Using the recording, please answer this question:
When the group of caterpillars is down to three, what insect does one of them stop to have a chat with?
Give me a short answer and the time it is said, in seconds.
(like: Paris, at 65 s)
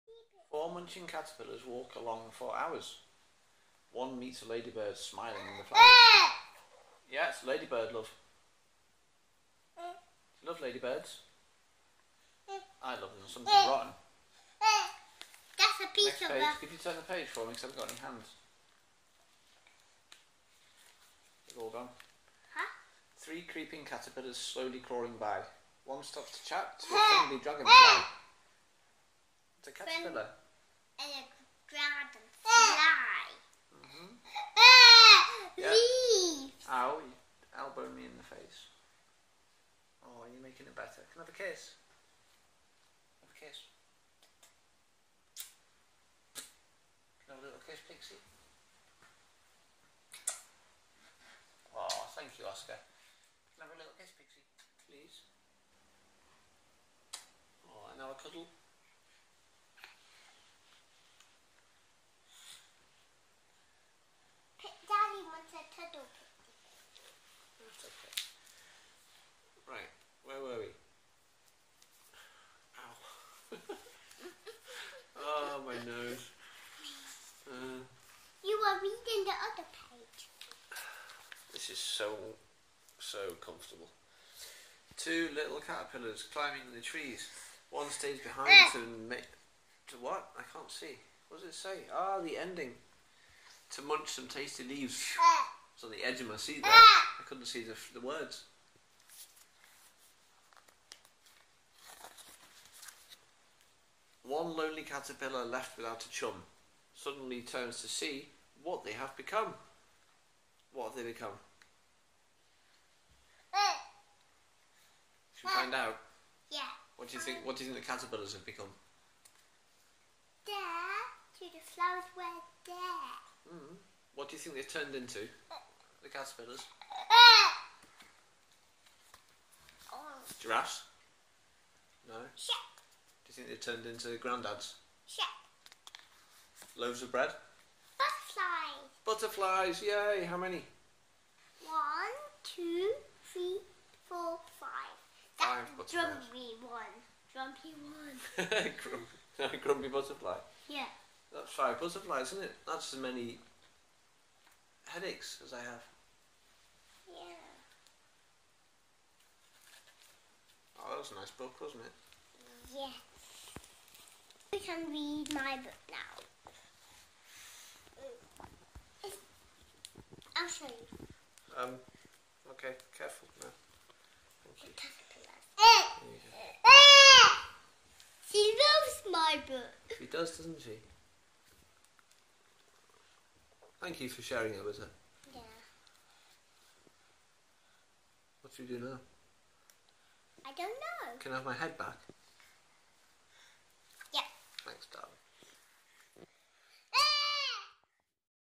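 dragonfly, at 27 s.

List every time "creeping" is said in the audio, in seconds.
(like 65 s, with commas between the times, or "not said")
23 s.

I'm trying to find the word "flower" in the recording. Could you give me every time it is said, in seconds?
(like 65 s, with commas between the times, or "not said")
5 s, 121 s.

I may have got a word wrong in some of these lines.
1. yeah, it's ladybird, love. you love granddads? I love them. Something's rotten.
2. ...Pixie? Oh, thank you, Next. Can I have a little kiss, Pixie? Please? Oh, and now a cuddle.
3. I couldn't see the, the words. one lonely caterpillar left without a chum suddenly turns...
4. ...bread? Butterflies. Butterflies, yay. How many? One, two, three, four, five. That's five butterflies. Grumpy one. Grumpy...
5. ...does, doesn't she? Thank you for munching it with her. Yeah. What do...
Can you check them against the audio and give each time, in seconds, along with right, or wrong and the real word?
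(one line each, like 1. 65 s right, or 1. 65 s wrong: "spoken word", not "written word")
1. 7 s wrong: "ladybirds", not "granddads"
2. 47 s wrong: "Oscar", not "Next"
3. 97 s right
4. 137 s right
5. 180 s wrong: "sharing", not "munching".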